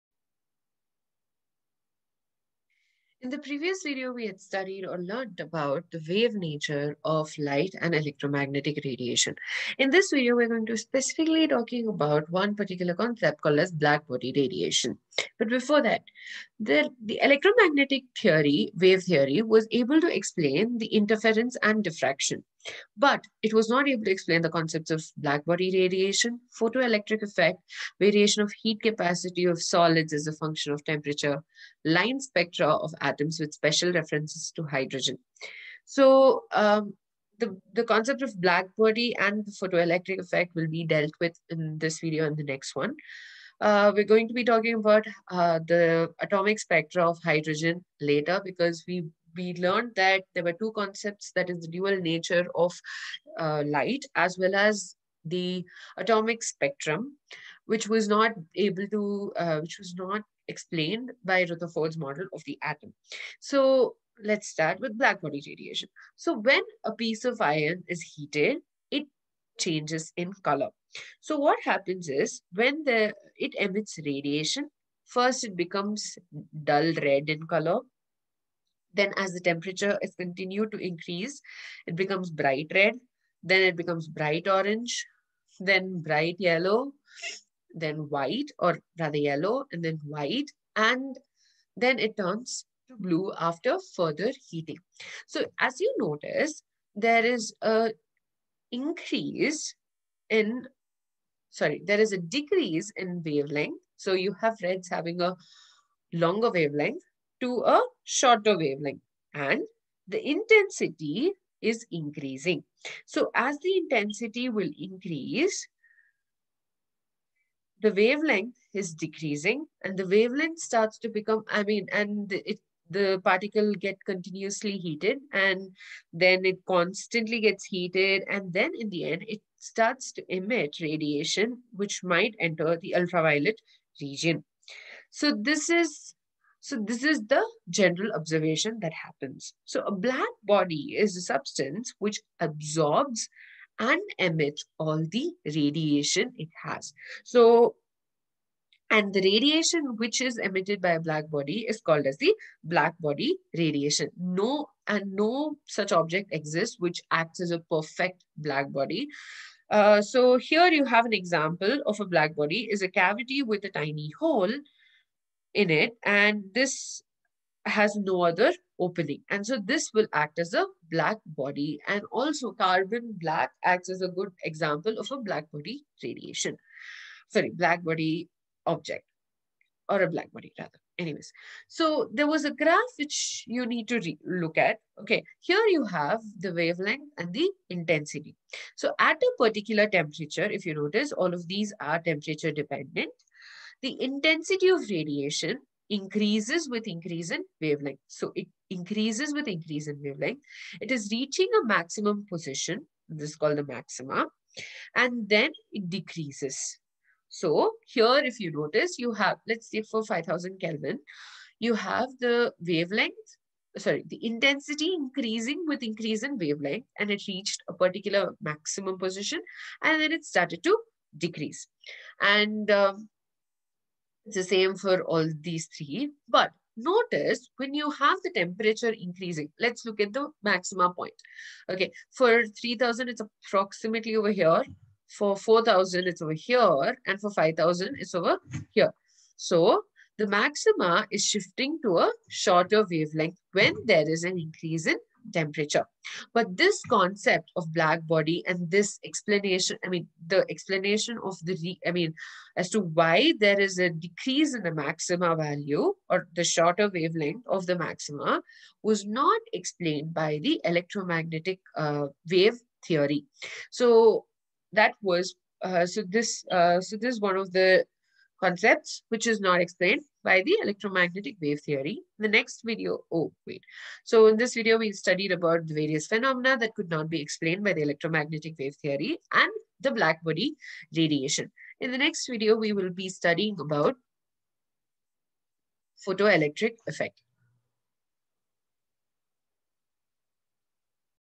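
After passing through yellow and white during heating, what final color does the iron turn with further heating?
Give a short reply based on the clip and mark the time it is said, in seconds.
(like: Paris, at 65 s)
blue, at 92 s.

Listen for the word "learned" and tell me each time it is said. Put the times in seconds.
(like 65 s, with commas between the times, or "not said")
4 s, 49 s.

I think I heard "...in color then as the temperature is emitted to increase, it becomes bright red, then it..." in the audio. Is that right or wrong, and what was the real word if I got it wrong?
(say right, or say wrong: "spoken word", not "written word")
wrong: "continued", not "emitted".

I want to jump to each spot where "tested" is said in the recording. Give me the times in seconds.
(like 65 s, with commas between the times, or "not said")
not said.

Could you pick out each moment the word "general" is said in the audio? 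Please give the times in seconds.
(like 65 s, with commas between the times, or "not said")
137 s.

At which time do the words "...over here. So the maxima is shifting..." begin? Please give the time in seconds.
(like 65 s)
238 s.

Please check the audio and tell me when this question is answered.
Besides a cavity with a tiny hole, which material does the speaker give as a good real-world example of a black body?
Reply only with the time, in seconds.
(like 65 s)
172 s.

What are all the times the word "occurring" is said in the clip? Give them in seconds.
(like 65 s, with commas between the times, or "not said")
not said.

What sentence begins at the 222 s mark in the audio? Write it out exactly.
And um, it's the same for all these three.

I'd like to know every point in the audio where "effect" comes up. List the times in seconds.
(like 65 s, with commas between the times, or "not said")
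27 s, 40 s, 286 s.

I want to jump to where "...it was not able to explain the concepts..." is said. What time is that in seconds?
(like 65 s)
23 s.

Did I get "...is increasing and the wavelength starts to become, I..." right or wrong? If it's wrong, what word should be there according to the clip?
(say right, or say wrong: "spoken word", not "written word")
wrong: "decreasing", not "increasing".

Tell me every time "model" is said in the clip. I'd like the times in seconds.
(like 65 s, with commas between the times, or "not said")
61 s.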